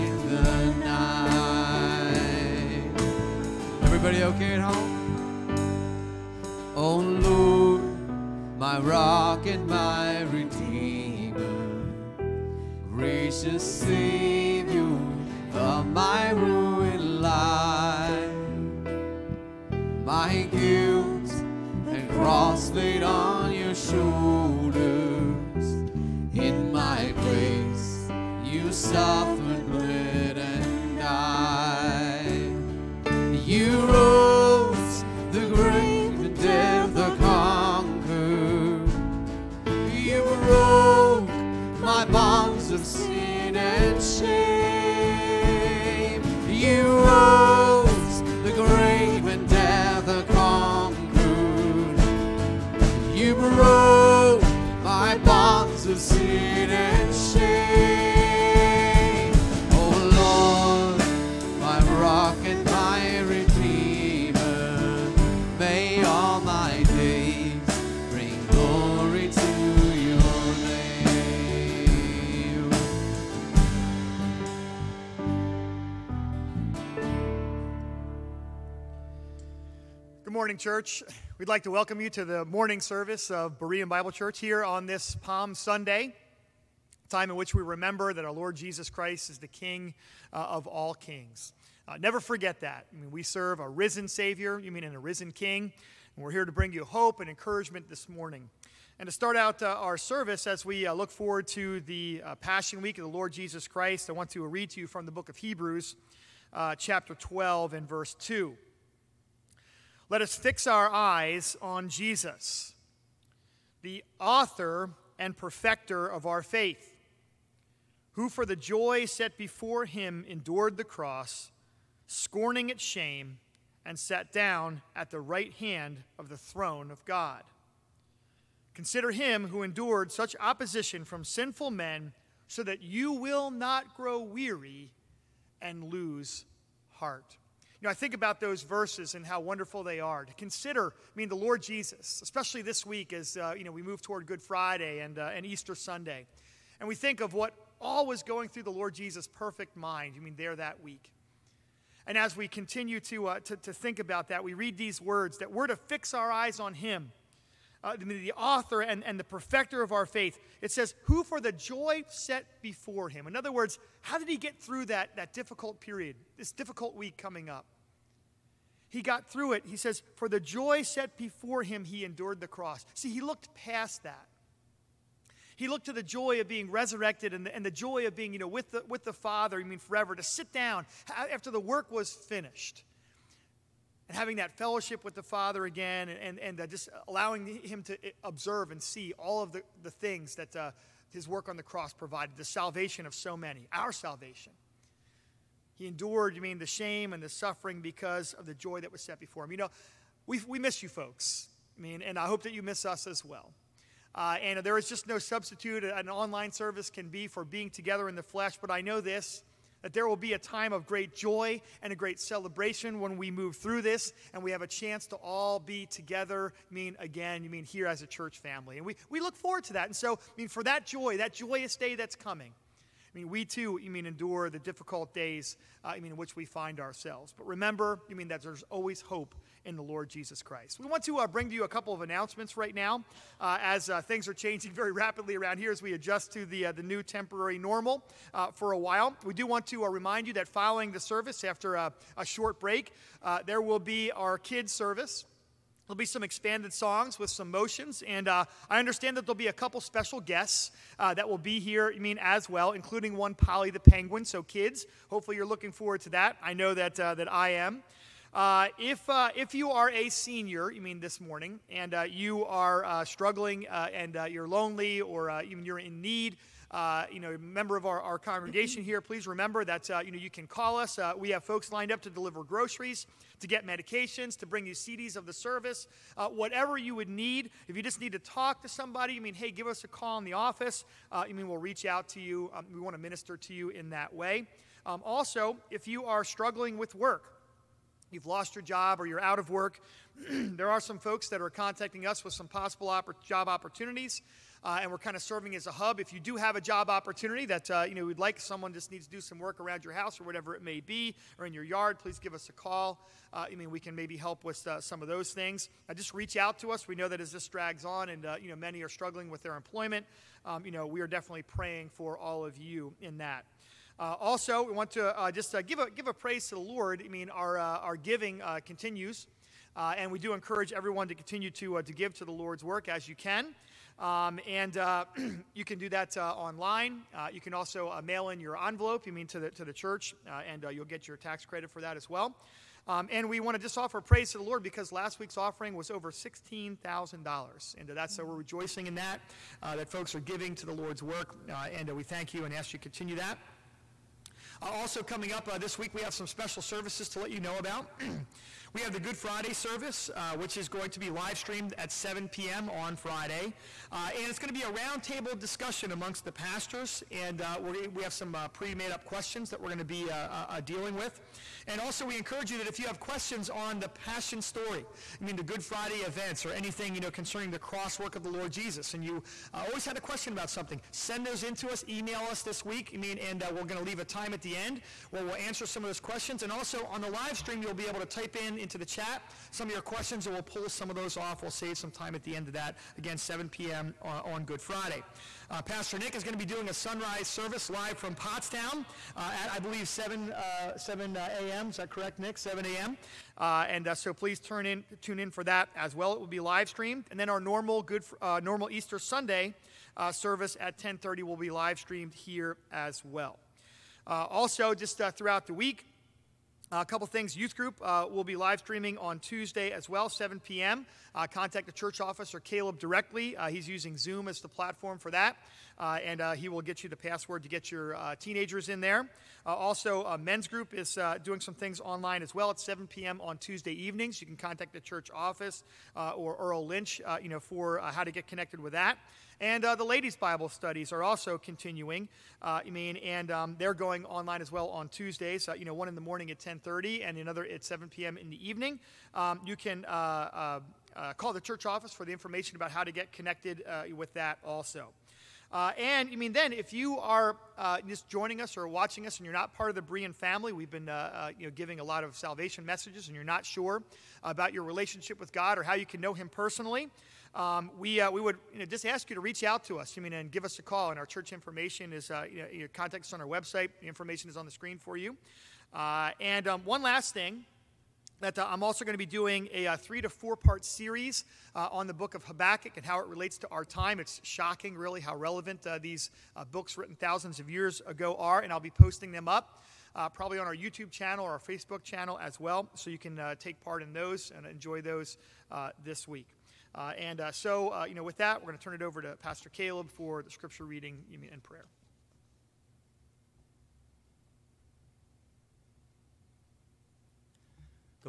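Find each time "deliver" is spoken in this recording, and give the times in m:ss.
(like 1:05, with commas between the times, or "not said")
4:32.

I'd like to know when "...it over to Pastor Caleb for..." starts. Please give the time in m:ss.
8:08.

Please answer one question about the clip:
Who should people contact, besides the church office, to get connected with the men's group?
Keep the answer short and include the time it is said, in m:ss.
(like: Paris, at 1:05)
Earl Lynch, at 7:06.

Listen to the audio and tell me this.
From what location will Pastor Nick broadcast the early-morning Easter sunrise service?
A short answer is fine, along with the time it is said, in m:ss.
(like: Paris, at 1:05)
Pottstown, at 6:28.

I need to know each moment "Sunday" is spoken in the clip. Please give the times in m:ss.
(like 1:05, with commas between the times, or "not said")
1:25, 2:25, 6:38.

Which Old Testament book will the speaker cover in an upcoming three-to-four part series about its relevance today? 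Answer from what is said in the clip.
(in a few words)
Habakkuk.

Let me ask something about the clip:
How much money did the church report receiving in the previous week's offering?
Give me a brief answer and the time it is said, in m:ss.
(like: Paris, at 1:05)
$16,000, at 5:36.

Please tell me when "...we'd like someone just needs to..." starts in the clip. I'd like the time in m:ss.
4:58.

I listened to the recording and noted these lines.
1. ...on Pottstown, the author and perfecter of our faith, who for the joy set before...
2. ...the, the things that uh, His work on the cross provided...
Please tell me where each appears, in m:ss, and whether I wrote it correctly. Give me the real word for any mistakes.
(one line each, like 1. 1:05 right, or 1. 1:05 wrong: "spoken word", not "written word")
1. 1:51 wrong: "Jesus", not "Pottstown"
2. 3:09 right.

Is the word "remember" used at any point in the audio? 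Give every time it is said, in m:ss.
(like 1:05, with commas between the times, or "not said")
1:27, 3:47, 4:29.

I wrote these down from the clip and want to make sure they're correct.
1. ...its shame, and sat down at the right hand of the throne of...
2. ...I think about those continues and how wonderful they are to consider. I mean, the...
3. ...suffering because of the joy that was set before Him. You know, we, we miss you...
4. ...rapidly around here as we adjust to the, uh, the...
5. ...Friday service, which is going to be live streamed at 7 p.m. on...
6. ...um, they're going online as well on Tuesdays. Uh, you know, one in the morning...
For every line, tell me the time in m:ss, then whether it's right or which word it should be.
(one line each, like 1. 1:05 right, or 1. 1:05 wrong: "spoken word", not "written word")
1. 2:02 right
2. 2:17 wrong: "verses", not "continues"
3. 3:17 right
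4. 3:54 right
5. 5:49 right
6. 7:13 right.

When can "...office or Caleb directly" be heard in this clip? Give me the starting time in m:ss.
6:51.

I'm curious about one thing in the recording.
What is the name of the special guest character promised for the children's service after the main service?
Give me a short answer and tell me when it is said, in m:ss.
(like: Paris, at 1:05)
Polly the Penguin, at 4:13.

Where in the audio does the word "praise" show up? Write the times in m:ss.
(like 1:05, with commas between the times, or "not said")
5:16, 5:34.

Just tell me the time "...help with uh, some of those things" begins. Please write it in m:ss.
5:04.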